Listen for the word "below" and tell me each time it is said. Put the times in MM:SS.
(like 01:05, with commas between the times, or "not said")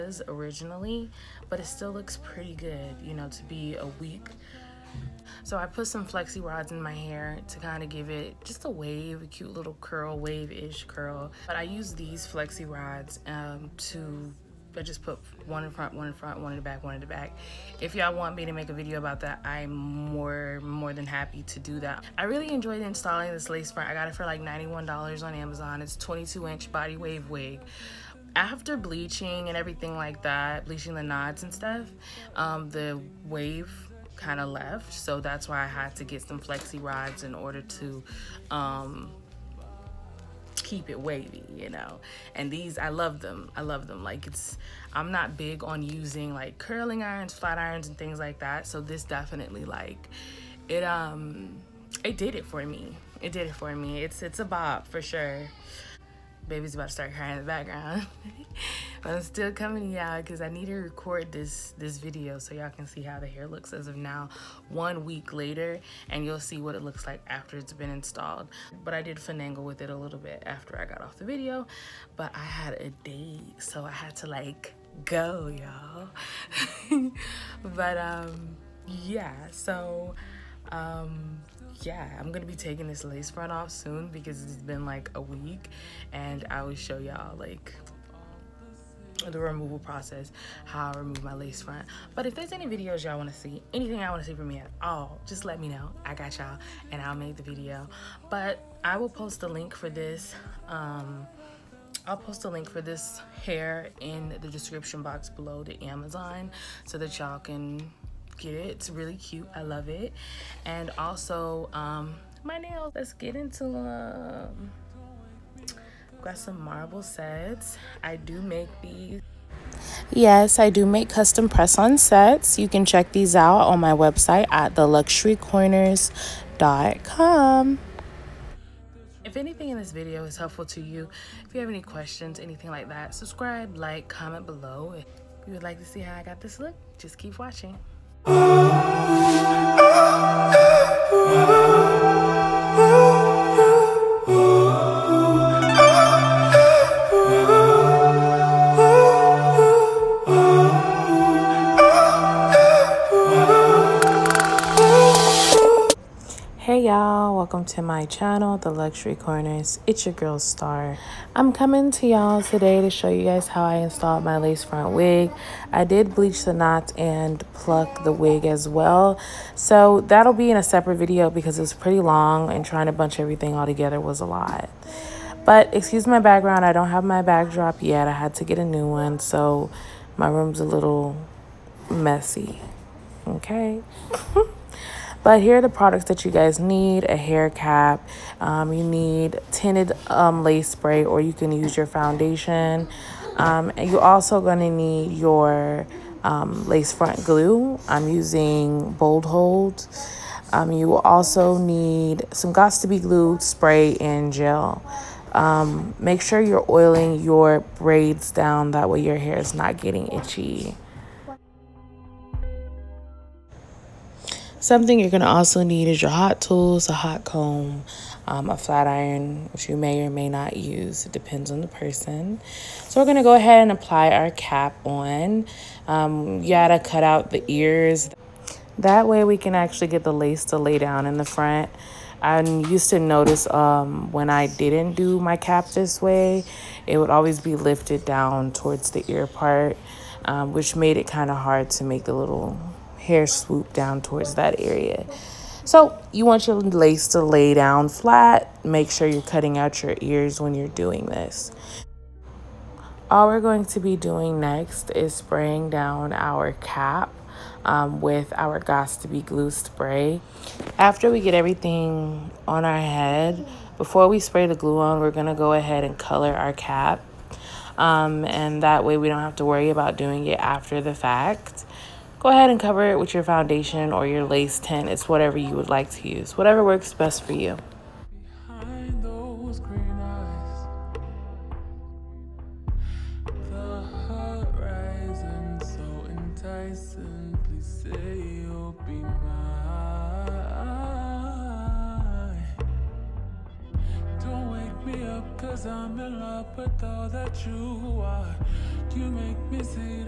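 01:45, 02:14.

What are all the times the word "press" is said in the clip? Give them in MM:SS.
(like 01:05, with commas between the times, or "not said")
02:01.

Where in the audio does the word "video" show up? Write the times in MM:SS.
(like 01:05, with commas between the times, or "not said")
00:18, 01:01, 01:11, 01:32, 01:37, 02:09, 02:50.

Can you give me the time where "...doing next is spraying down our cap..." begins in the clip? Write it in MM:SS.
04:13.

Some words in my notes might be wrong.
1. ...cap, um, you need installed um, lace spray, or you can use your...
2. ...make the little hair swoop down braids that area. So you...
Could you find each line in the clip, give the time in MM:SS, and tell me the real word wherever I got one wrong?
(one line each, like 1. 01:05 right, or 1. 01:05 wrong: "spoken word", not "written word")
1. 03:07 wrong: "tinted", not "installed"
2. 04:01 wrong: "towards", not "braids".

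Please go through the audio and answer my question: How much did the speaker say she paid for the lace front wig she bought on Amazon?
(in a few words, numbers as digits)
$91.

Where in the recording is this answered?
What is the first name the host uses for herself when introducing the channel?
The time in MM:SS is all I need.
02:40.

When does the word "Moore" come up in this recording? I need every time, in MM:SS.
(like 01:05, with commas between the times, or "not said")
not said.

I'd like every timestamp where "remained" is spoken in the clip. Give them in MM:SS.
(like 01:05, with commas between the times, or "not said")
not said.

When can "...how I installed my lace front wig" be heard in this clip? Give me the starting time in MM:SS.
02:43.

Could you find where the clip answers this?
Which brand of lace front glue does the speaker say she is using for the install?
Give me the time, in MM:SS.
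03:18.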